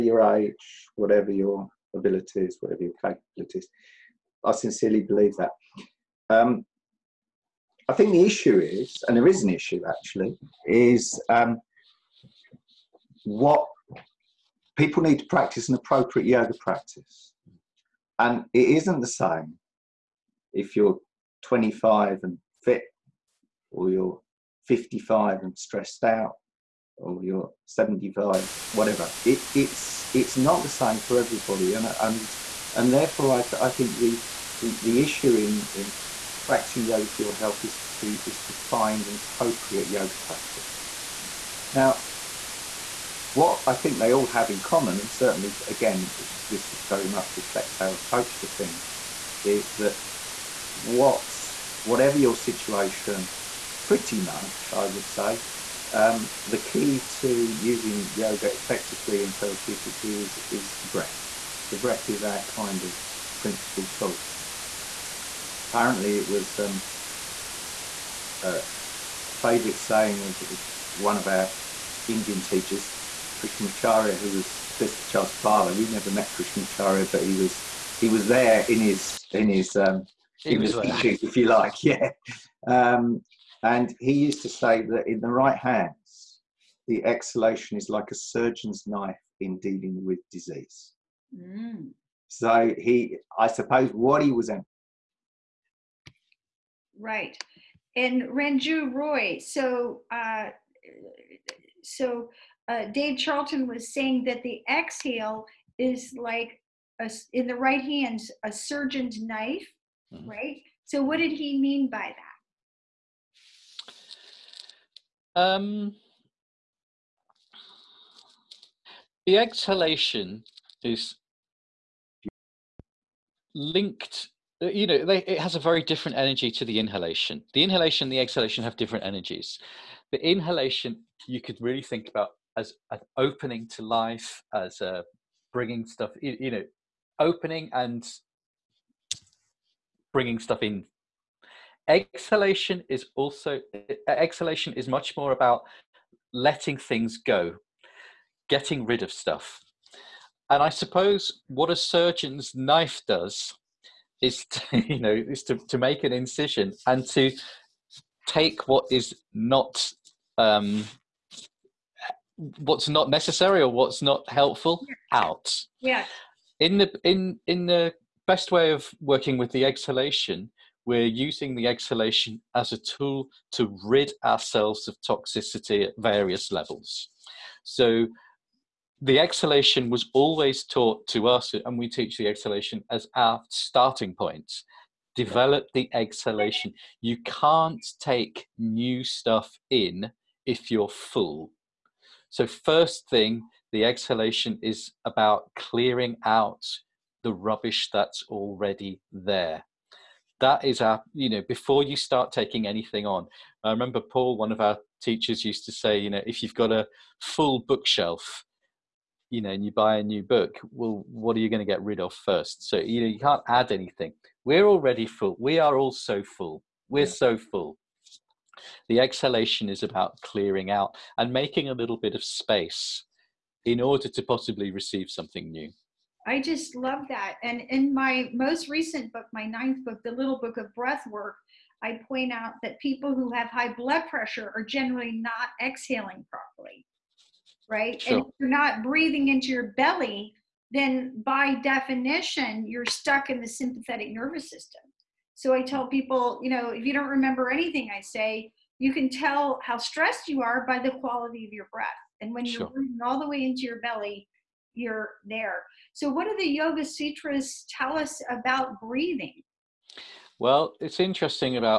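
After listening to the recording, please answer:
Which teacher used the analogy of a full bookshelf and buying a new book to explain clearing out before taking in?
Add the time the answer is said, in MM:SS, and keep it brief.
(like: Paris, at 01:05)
Paul, at 03:23.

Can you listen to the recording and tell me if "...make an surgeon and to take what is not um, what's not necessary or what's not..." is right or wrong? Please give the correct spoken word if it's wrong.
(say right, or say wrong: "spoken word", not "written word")
wrong: "incision", not "surgeon".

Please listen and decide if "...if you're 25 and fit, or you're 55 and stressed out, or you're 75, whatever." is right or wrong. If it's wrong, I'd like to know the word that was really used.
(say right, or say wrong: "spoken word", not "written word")
right.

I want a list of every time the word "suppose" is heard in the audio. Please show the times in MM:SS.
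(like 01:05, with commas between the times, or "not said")
01:33, 02:30.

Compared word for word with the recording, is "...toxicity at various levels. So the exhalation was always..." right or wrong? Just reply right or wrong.
right.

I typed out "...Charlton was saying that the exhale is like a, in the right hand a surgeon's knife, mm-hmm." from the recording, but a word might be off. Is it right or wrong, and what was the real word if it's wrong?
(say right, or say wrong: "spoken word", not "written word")
right.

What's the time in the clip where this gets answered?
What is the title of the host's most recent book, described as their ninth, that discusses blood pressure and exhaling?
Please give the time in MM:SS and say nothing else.
03:50.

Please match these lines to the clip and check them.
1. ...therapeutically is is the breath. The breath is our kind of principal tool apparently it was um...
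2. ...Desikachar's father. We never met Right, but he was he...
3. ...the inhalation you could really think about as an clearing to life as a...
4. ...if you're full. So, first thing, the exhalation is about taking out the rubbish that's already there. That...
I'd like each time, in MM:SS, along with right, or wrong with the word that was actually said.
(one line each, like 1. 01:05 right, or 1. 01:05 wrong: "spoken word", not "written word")
1. 00:59 right
2. 01:14 wrong: "Krishnamacharya", not "Right"
3. 02:10 wrong: "opening", not "clearing"
4. 03:10 wrong: "clearing", not "taking".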